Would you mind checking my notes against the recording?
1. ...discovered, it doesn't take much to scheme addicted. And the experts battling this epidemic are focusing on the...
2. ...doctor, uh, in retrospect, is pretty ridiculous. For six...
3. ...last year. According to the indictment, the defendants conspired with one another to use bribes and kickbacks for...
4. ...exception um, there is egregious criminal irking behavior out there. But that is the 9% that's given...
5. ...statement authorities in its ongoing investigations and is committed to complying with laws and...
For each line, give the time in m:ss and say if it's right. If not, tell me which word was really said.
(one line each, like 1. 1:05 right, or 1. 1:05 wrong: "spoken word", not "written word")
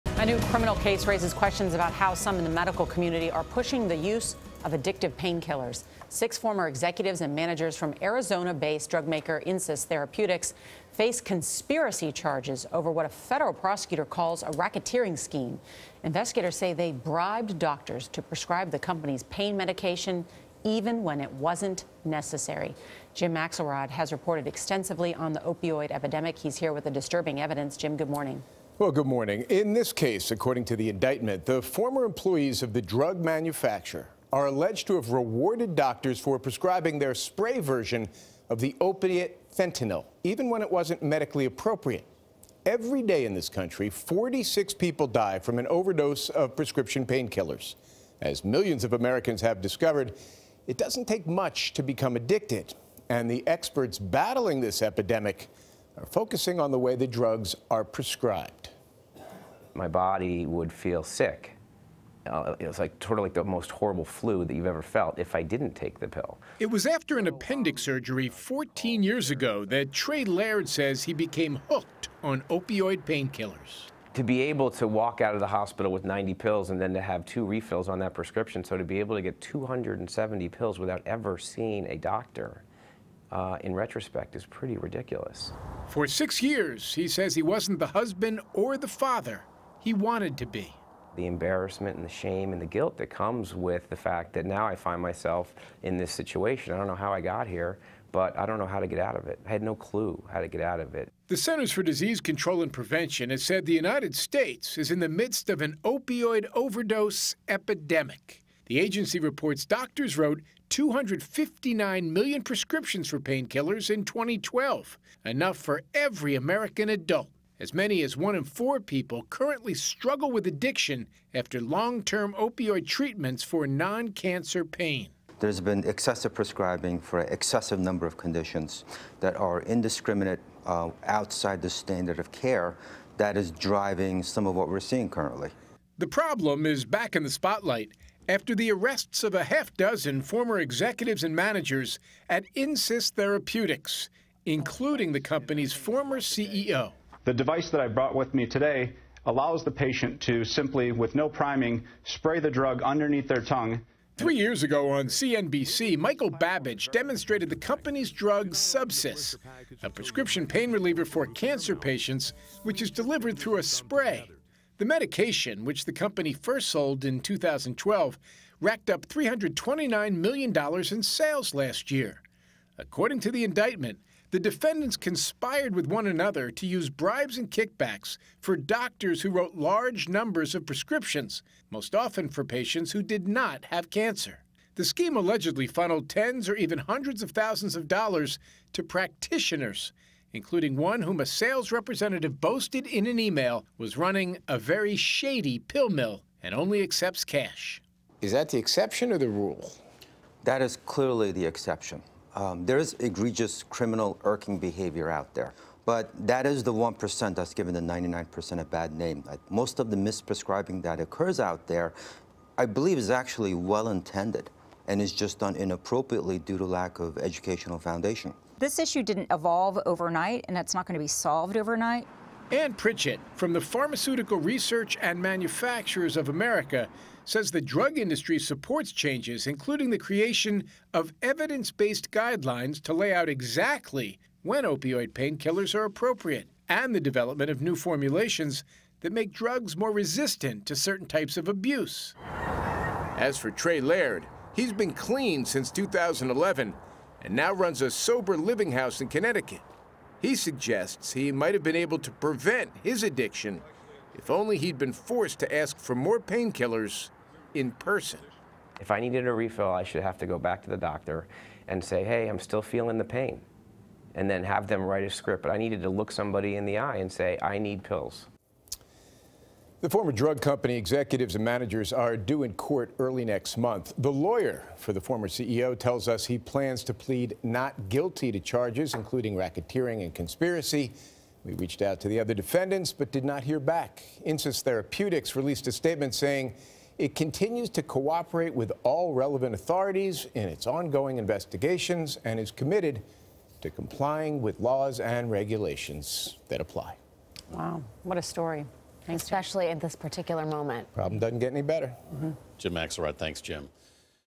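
1. 0:49 wrong: "become", not "scheme"
2. 1:21 right
3. 2:51 right
4. 3:21 wrong: "1", not "9"
5. 4:49 wrong: "relevant", not "statement".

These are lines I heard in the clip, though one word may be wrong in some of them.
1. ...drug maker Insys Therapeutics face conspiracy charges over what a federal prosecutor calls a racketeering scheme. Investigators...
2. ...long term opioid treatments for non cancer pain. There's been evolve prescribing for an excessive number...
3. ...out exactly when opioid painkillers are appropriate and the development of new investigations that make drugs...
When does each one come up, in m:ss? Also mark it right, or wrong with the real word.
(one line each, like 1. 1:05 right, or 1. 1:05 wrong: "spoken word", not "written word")
1. 0:08 right
2. 2:01 wrong: "excessive", not "evolve"
3. 3:53 wrong: "formulations", not "investigations".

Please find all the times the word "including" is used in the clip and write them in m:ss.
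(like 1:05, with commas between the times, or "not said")
2:24, 3:10, 3:49, 4:38.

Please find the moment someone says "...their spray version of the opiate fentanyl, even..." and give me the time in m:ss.
0:36.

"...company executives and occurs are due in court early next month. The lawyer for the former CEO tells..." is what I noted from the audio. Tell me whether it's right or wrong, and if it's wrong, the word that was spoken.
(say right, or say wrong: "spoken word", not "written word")
wrong: "managers", not "occurs".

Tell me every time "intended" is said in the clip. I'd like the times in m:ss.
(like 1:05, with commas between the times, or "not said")
3:33.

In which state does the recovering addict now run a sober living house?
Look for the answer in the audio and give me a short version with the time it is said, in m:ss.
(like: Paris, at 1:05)
Connecticut, at 4:09.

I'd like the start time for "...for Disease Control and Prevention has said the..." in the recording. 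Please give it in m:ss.
1:41.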